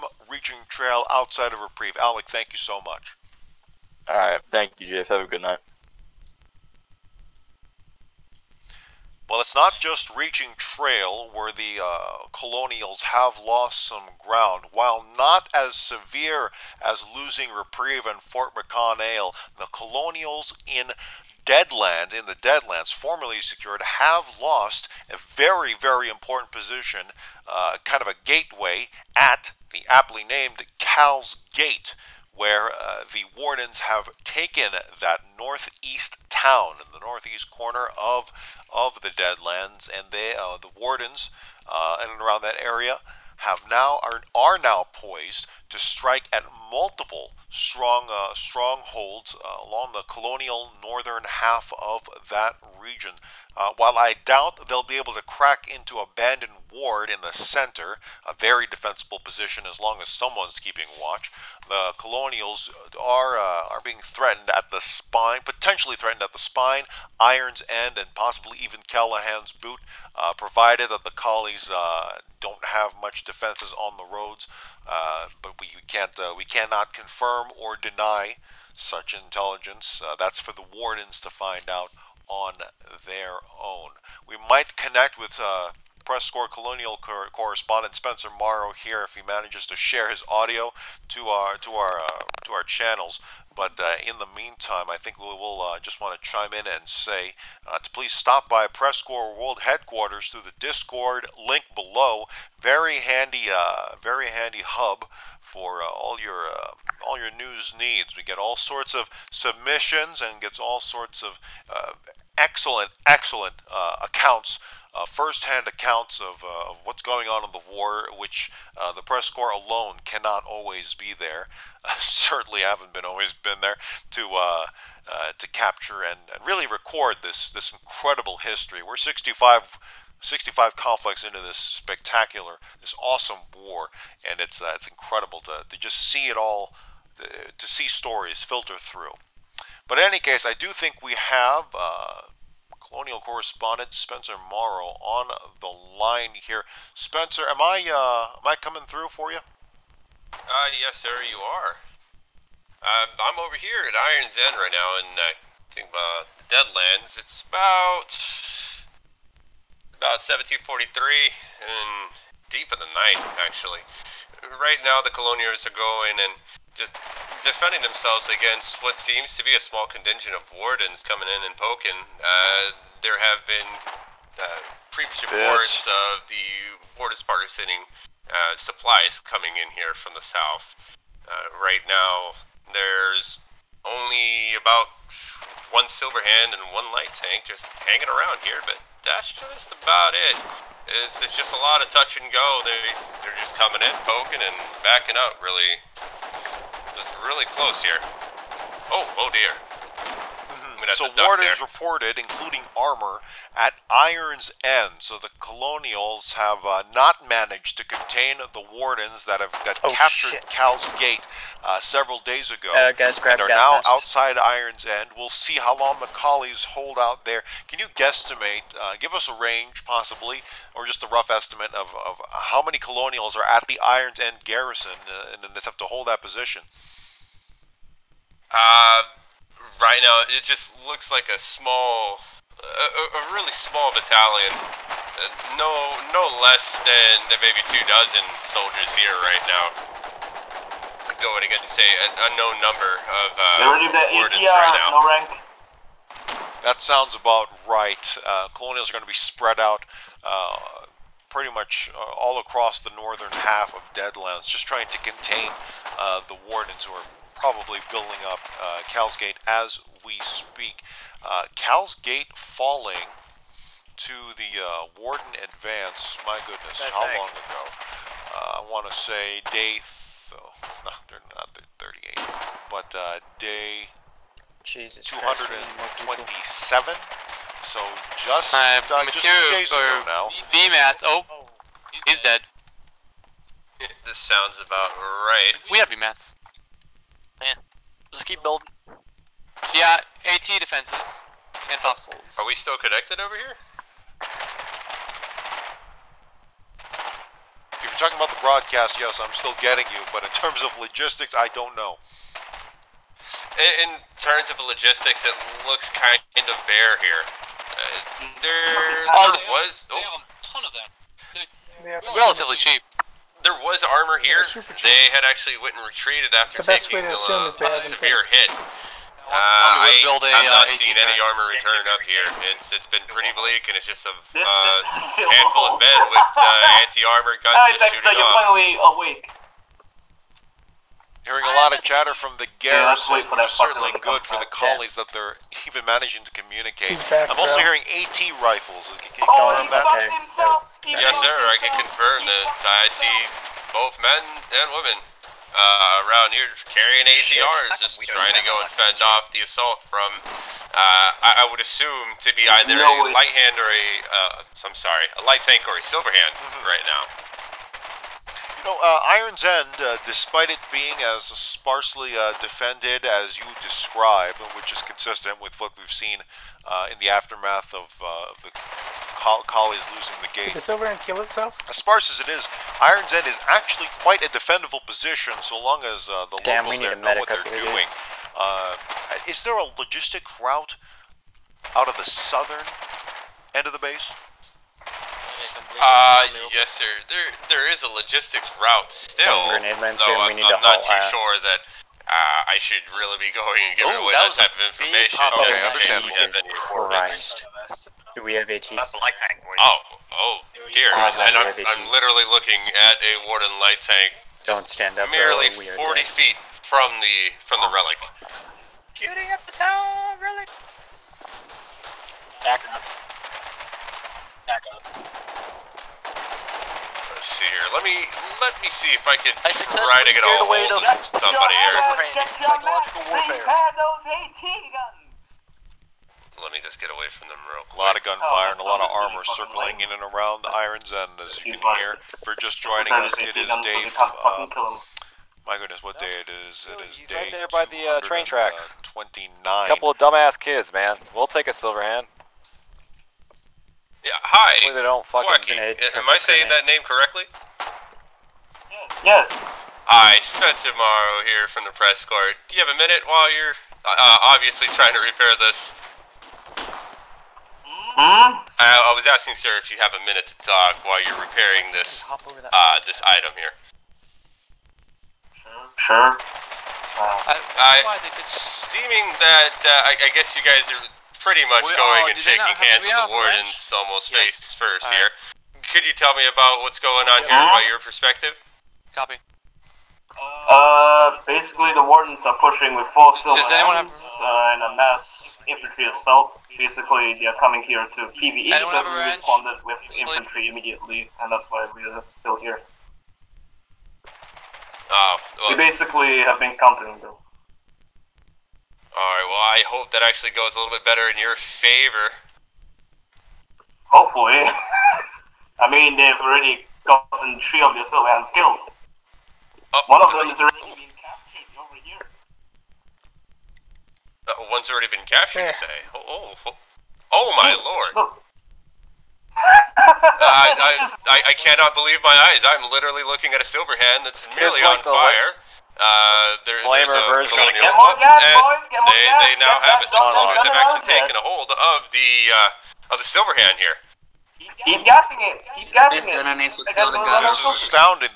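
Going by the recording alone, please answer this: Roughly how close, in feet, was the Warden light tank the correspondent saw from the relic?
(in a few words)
40 feet.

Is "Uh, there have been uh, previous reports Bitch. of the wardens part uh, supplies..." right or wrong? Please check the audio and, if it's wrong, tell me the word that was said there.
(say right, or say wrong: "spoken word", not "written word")
right.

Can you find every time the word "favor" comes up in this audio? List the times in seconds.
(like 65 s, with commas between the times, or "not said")
501 s.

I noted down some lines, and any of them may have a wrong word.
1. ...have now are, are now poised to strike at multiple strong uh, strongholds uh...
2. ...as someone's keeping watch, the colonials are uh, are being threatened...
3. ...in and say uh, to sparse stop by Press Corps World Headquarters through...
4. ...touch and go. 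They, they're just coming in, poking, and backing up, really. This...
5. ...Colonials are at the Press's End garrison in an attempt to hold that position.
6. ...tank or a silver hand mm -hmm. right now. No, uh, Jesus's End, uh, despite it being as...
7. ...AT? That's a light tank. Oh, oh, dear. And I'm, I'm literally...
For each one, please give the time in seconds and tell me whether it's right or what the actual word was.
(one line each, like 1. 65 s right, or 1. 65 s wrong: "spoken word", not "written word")
1. 43 s right
2. 59 s right
3. 96 s wrong: "please", not "sparse"
4. 191 s right
5. 222 s wrong: "Iron", not "Press"
6. 355 s wrong: "Iron", not "Jesus"
7. 398 s right.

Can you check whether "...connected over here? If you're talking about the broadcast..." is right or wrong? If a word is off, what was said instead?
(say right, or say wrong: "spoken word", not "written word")
right.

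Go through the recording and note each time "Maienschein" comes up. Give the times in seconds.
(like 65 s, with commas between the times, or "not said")
not said.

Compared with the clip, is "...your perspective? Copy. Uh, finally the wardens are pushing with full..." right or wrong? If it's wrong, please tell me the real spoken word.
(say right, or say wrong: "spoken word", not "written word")
wrong: "basically", not "finally".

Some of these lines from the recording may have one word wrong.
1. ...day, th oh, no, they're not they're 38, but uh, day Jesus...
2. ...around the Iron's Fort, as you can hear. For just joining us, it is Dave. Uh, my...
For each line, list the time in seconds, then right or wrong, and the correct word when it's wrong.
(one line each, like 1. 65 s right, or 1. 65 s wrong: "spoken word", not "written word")
1. 269 s right
2. 430 s wrong: "End", not "Fort".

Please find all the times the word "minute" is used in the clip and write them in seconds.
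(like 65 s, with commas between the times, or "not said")
452 s, 460 s.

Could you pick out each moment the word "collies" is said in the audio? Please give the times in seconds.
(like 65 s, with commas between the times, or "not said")
71 s, 216 s, 334 s, 369 s.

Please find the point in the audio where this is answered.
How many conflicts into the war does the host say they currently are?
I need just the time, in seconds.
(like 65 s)
130 s.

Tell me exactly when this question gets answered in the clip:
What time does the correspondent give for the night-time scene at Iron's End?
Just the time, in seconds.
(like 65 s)
160 s.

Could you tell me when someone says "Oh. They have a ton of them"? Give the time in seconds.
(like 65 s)
309 s.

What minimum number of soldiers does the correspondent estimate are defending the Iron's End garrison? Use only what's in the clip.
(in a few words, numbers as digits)
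Two dozen.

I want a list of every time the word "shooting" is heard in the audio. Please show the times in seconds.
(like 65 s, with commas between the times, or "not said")
327 s, 408 s.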